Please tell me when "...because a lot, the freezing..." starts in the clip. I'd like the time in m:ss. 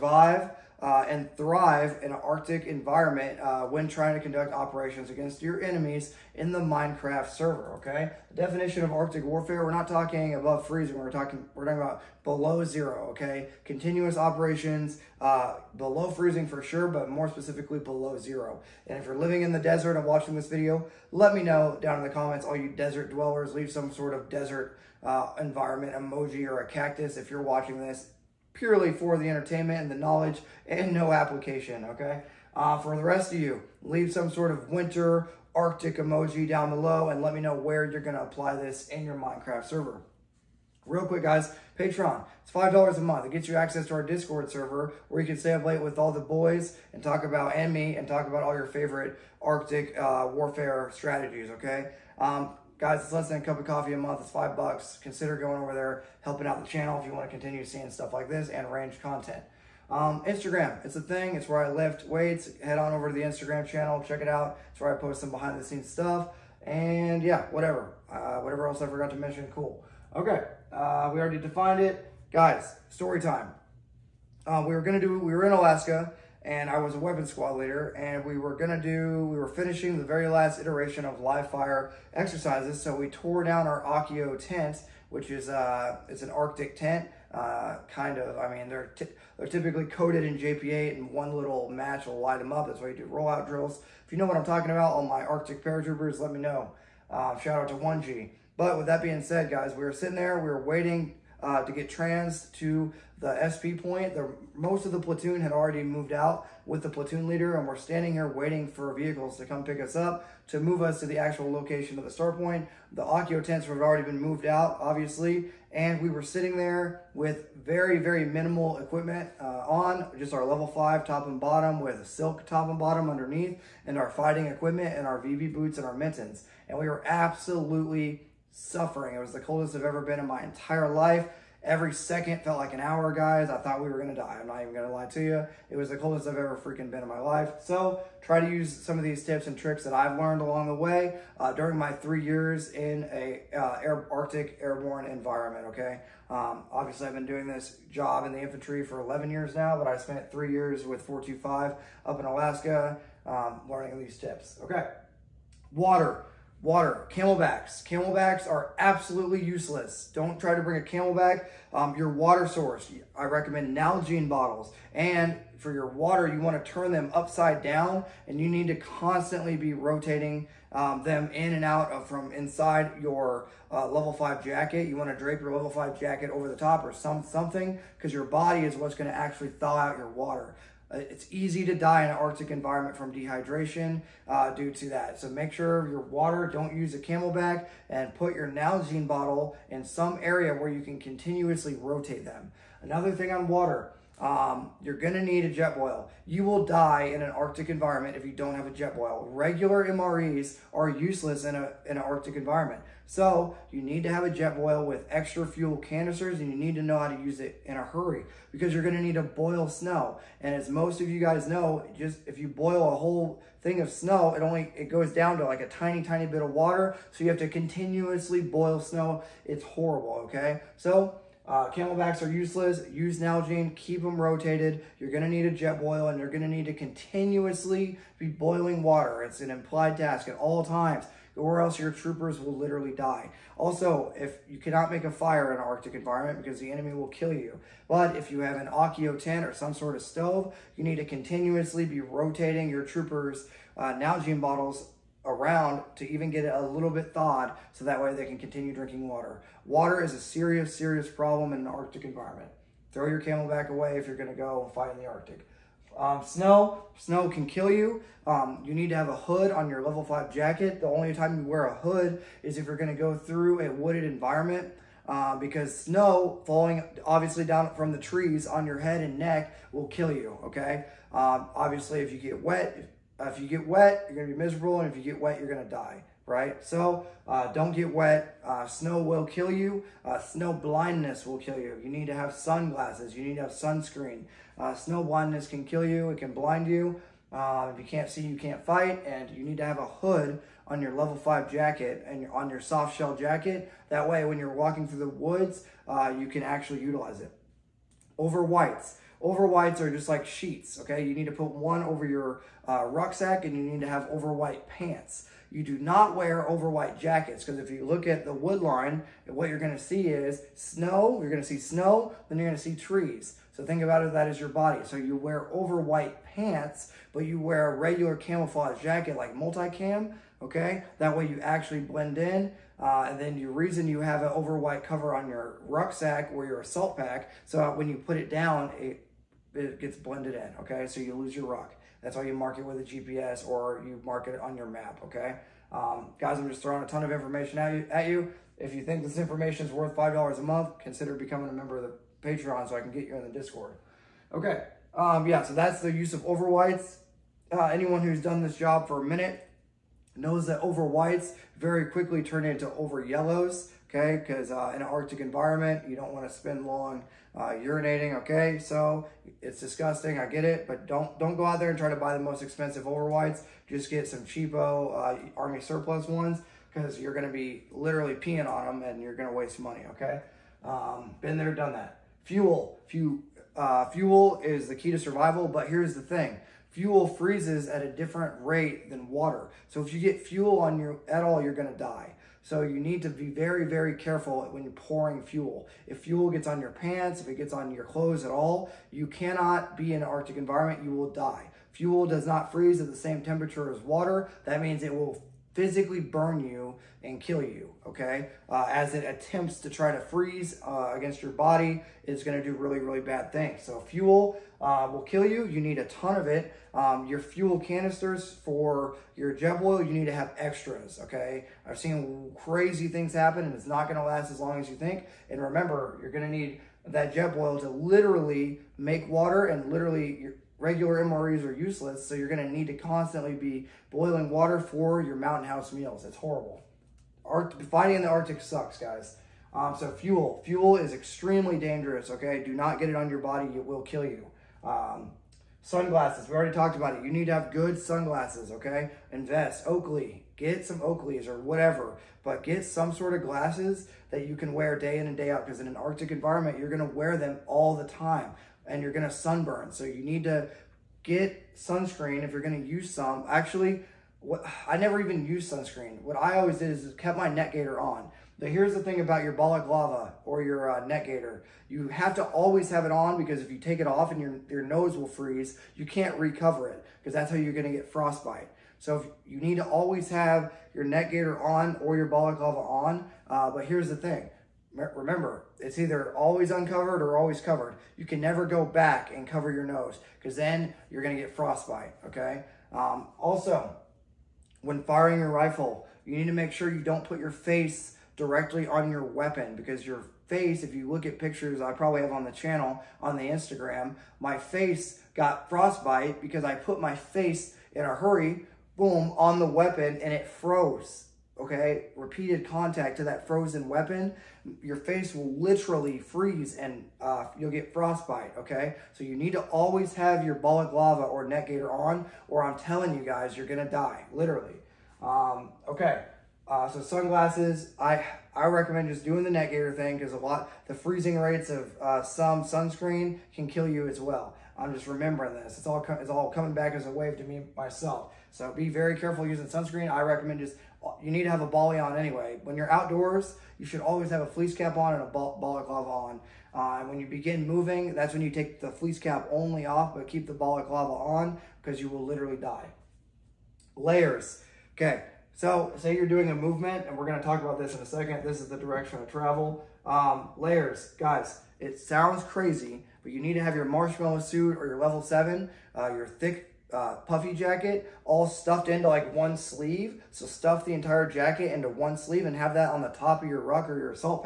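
8:39.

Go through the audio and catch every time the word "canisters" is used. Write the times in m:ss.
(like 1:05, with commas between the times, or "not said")
3:25, 6:47.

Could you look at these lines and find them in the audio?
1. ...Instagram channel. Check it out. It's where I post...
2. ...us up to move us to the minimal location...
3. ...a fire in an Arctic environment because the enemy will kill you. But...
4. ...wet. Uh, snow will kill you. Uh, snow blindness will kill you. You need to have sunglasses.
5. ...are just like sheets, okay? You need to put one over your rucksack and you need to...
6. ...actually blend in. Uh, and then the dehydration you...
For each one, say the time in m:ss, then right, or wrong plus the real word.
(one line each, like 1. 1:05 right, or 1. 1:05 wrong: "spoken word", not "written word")
1. 1:03 right
2. 1:49 wrong: "actual", not "minimal"
3. 3:55 right
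4. 4:37 right
5. 4:59 right
6. 5:21 wrong: "reason", not "dehydration".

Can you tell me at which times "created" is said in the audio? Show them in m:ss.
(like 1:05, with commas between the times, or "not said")
not said.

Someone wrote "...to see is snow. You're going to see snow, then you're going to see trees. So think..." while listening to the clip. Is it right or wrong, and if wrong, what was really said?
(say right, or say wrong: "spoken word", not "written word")
right.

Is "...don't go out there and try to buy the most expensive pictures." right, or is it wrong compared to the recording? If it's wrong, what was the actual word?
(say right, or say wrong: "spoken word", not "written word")
wrong: "overwhites", not "pictures".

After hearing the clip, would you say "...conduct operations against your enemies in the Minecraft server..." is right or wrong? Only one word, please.
right.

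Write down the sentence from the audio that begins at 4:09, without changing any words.
Water is a serious, serious problem in an Arctic environment.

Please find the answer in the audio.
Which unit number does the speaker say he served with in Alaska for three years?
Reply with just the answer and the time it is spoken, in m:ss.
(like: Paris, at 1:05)
425, at 2:31.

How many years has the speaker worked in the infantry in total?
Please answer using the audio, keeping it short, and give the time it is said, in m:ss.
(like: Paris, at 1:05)
11, at 2:29.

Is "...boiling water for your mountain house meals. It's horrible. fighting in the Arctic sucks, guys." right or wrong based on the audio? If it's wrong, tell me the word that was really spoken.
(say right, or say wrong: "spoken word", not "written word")
right.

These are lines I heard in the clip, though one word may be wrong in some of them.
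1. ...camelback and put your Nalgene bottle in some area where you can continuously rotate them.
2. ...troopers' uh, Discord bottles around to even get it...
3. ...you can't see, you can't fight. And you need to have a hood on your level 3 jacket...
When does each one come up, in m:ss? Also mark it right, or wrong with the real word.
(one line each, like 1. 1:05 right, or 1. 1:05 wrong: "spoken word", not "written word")
1. 3:06 right
2. 4:02 wrong: "Nalgene", not "Discord"
3. 4:47 wrong: "5", not "3".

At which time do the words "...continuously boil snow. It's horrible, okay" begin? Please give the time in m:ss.
3:37.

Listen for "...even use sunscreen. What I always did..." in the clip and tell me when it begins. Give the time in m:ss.
7:34.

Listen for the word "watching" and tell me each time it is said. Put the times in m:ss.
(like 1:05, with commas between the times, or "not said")
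0:20, 0:27.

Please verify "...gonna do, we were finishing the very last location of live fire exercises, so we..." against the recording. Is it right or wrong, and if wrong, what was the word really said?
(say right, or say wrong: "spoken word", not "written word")
wrong: "iteration", not "location".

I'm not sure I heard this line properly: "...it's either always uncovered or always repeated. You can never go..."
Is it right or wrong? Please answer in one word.
wrong.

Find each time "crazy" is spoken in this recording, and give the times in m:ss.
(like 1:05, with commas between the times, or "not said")
6:52, 9:12.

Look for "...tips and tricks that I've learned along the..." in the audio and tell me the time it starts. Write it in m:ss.
2:19.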